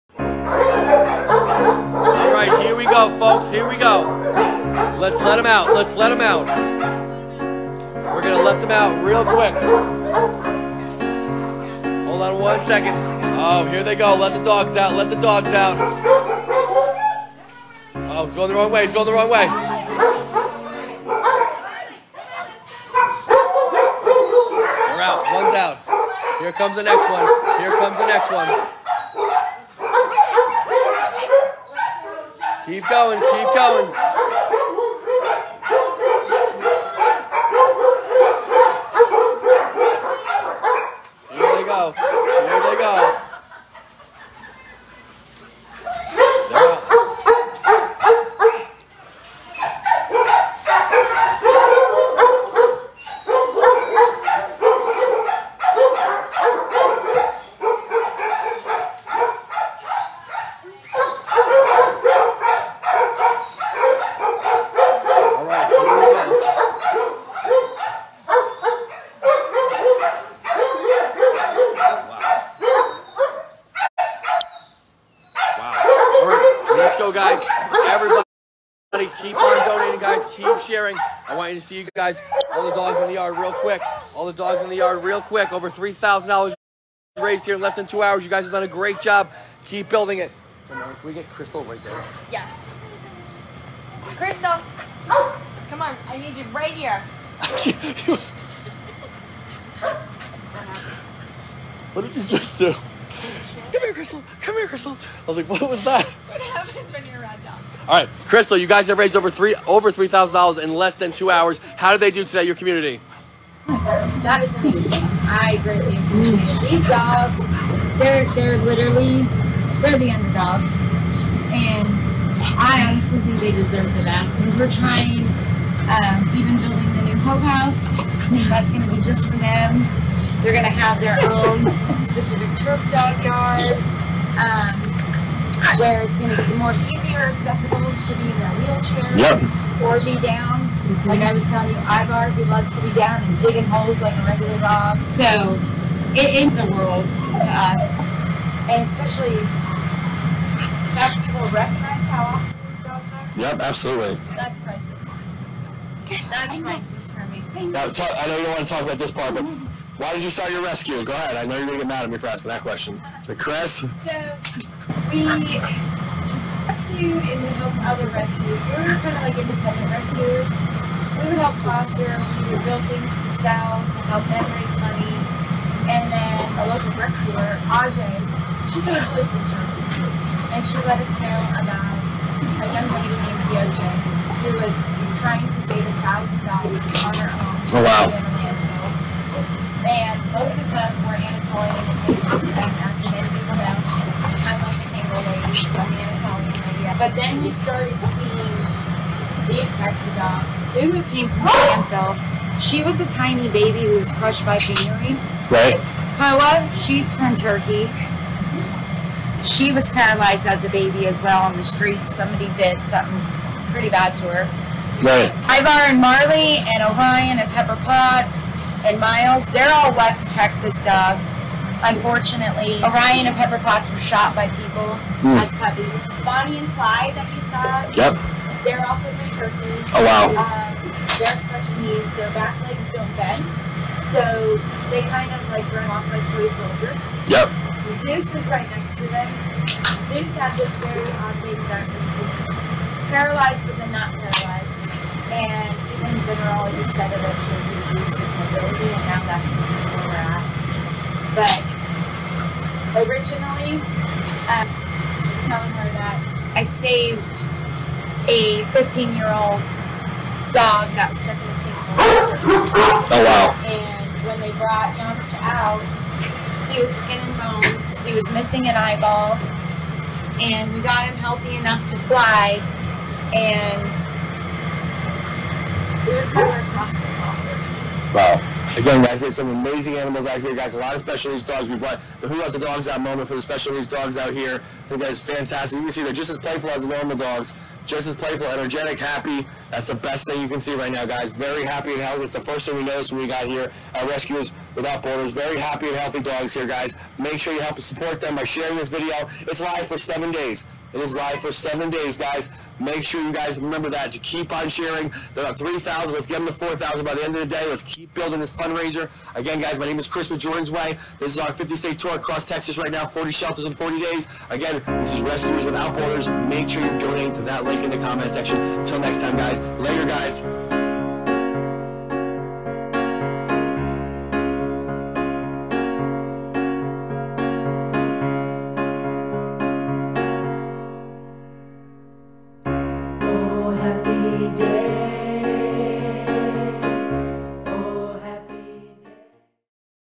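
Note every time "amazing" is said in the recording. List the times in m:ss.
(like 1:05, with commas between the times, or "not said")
1:54, 4:39.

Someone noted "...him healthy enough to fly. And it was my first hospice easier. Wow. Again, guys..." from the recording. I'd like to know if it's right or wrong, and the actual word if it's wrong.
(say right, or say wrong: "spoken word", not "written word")
wrong: "foster", not "easier".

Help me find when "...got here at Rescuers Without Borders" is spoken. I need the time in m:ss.
4:53.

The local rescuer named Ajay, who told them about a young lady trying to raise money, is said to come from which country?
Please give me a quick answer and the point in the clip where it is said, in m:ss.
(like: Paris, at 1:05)
Germany, at 2:59.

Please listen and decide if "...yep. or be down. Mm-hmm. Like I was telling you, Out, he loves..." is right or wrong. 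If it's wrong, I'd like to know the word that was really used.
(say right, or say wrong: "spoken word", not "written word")
wrong: "Ivar", not "Out".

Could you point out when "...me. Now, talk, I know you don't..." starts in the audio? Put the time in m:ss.
2:37.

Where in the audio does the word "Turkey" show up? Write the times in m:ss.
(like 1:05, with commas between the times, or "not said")
3:27, 3:49.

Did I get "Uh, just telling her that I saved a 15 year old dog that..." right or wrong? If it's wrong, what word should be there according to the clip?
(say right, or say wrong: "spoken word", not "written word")
right.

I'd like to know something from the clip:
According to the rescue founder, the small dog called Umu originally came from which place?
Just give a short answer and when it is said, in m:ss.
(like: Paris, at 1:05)
Banfield, at 3:21.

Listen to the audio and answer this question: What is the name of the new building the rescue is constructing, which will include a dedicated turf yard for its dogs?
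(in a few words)
Hope House.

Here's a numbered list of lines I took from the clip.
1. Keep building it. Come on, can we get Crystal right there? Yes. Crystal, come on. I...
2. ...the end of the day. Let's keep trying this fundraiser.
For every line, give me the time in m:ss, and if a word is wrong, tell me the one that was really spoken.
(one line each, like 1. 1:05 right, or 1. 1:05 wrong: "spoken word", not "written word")
1. 1:29 right
2. 5:07 wrong: "building", not "trying".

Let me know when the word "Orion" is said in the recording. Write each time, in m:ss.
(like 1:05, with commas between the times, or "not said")
3:36, 3:42.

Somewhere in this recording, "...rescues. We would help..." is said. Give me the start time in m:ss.
2:49.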